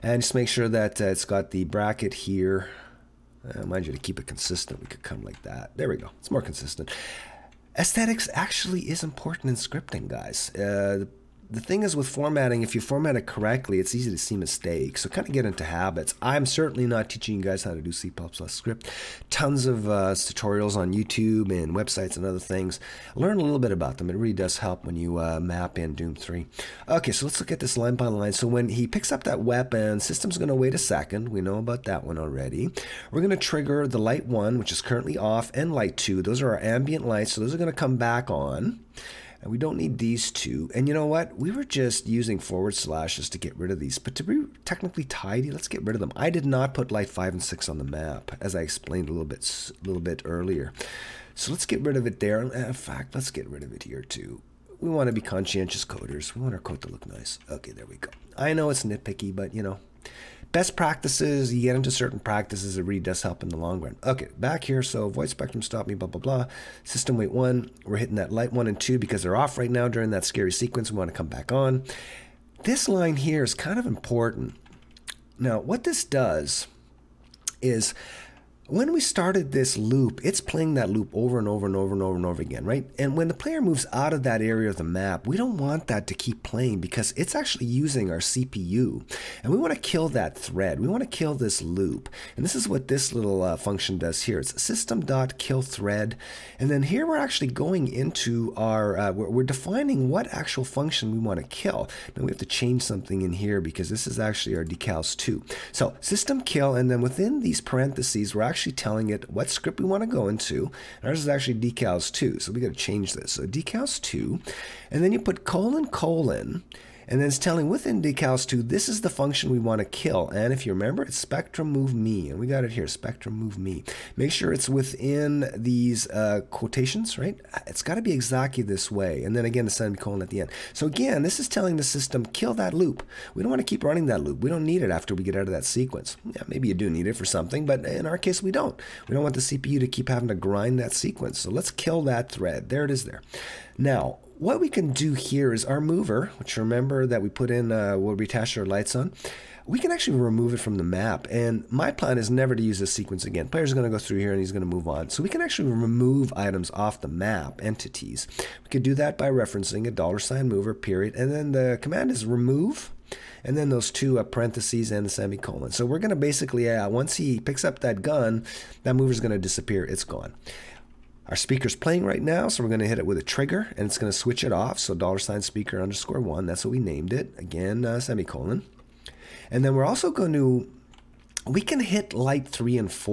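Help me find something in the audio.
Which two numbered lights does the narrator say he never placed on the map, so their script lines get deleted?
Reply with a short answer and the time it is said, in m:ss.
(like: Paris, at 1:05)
5 and 6, at 0:46.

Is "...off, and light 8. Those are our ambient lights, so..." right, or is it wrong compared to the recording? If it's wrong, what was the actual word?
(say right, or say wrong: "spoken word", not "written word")
wrong: "2", not "8".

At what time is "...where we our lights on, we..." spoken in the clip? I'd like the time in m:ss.
2:27.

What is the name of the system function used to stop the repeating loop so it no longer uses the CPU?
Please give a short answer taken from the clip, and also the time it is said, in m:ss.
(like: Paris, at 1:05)
system.killThread, at 1:34.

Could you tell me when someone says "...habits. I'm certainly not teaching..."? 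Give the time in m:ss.
0:15.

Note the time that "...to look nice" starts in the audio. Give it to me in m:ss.
0:56.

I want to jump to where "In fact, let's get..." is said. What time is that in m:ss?
0:52.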